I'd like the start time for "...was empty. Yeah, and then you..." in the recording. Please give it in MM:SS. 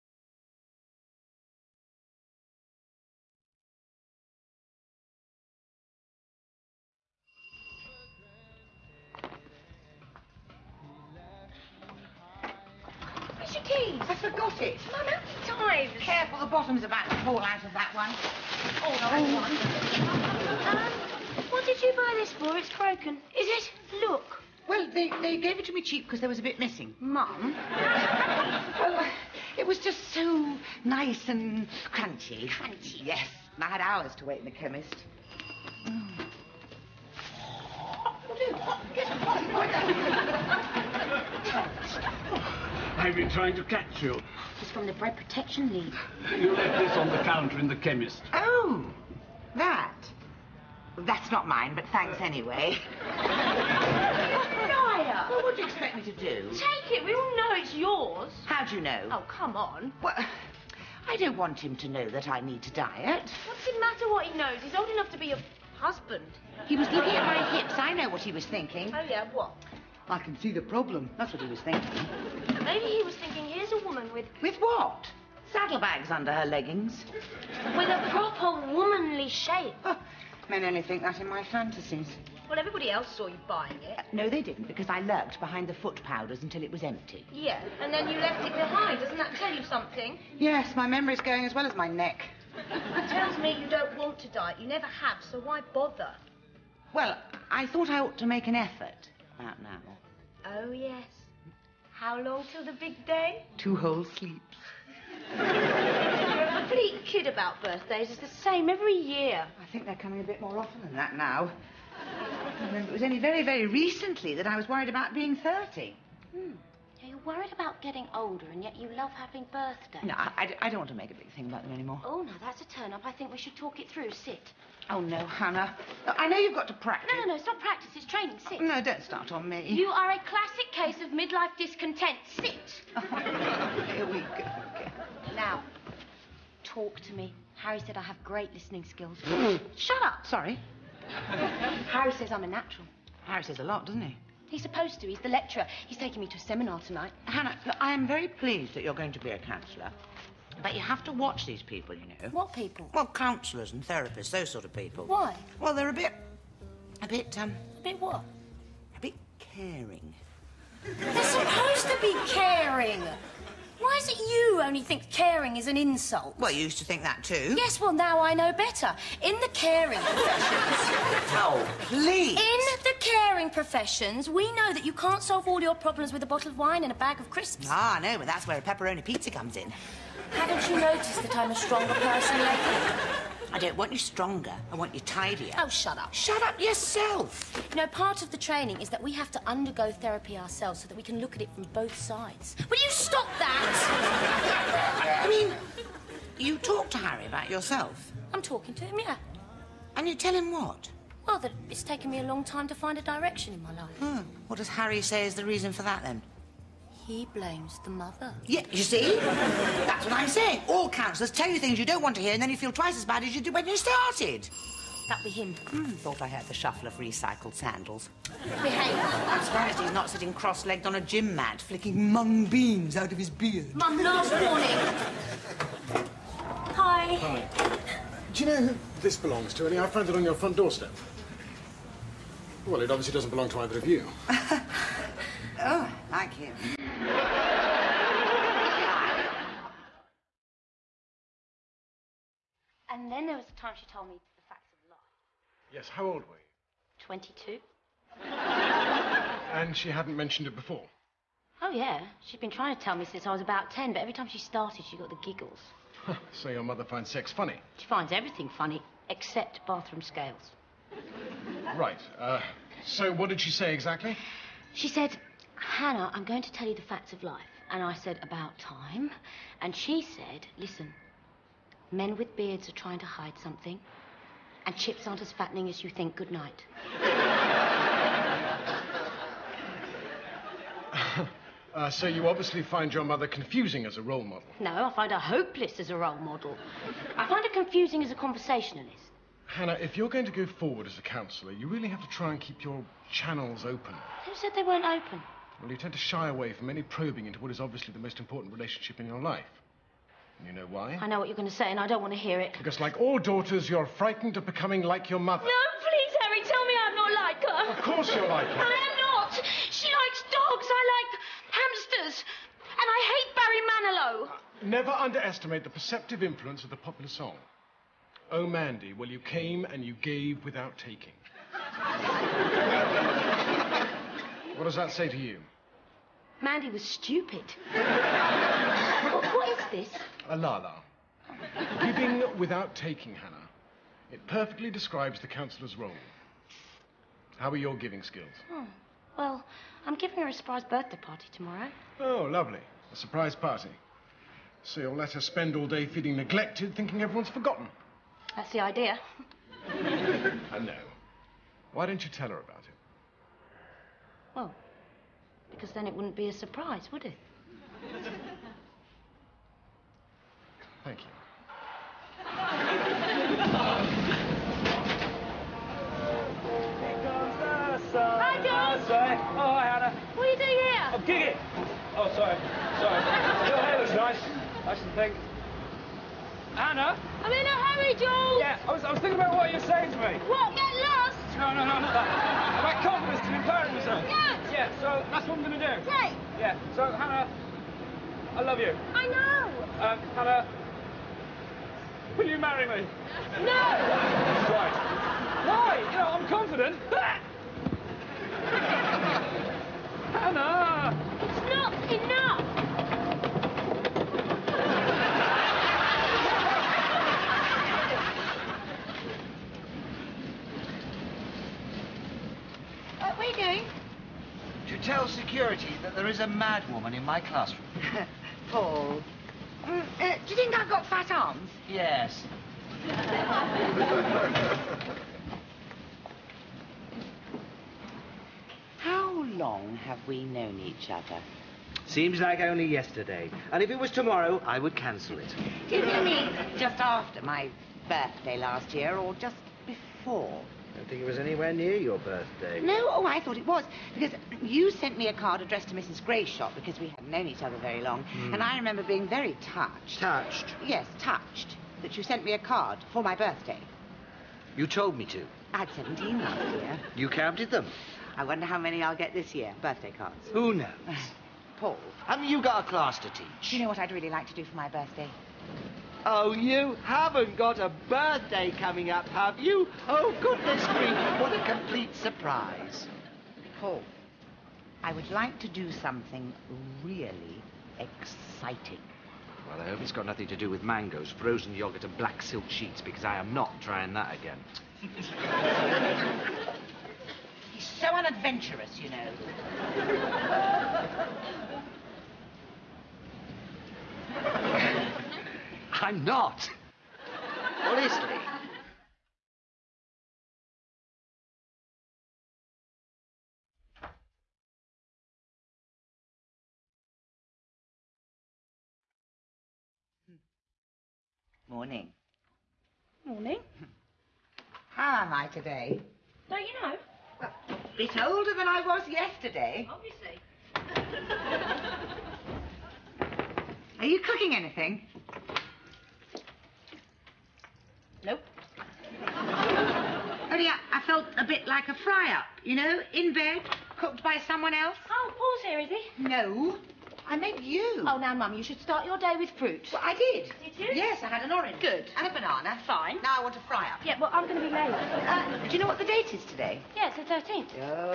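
01:26.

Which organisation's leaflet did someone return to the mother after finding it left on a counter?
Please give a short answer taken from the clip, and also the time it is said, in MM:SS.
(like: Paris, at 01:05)
Bread Protection League, at 00:44.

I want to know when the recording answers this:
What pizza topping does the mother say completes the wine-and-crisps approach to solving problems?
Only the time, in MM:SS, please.
02:58.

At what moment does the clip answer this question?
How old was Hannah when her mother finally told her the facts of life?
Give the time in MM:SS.
04:07.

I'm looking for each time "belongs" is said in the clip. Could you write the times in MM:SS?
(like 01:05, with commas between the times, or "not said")
03:49, 03:53.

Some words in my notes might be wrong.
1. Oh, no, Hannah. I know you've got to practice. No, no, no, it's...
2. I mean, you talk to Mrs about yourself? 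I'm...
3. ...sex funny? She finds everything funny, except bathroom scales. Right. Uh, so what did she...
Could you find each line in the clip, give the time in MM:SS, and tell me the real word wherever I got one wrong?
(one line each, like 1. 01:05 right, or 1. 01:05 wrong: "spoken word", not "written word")
1. 02:04 right
2. 03:15 wrong: "Harry", not "Mrs"
3. 04:17 right.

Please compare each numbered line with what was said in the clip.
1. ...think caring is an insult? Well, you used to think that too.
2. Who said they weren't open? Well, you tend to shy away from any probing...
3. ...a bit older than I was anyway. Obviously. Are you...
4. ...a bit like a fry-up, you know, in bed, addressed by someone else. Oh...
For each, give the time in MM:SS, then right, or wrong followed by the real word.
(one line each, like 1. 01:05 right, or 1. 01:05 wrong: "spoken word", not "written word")
1. 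02:44 right
2. 04:54 right
3. 08:37 wrong: "yesterday", not "anyway"
4. 08:51 wrong: "cooked", not "addressed".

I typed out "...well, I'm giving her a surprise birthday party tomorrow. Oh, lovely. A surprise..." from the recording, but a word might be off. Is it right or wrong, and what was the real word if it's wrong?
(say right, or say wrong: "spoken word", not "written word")
right.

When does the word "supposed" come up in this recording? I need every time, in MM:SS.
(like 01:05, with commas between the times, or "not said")
02:24, 02:41.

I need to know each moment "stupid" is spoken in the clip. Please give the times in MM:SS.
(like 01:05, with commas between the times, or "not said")
05:26.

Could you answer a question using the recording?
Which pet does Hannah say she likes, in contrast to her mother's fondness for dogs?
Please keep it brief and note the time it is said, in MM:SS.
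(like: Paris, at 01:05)
hamsters, at 05:11.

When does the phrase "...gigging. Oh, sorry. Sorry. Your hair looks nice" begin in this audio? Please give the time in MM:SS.
06:11.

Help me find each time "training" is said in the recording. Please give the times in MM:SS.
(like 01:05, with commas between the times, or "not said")
02:08, 03:08.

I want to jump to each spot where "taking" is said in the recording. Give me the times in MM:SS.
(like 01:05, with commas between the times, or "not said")
02:25, 05:20, 05:32.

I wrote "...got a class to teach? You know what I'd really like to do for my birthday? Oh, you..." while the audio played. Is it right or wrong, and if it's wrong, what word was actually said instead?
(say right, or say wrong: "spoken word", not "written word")
right.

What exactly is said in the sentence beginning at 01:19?
Oh, men only think that in my fantasies.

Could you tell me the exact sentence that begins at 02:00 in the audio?
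No, I, I, I, don't want to make a big thing about them anymore.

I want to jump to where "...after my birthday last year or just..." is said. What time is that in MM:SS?
07:16.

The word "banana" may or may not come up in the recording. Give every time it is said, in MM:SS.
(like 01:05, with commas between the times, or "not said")
09:02.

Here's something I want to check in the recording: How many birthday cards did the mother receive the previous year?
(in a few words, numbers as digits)
17.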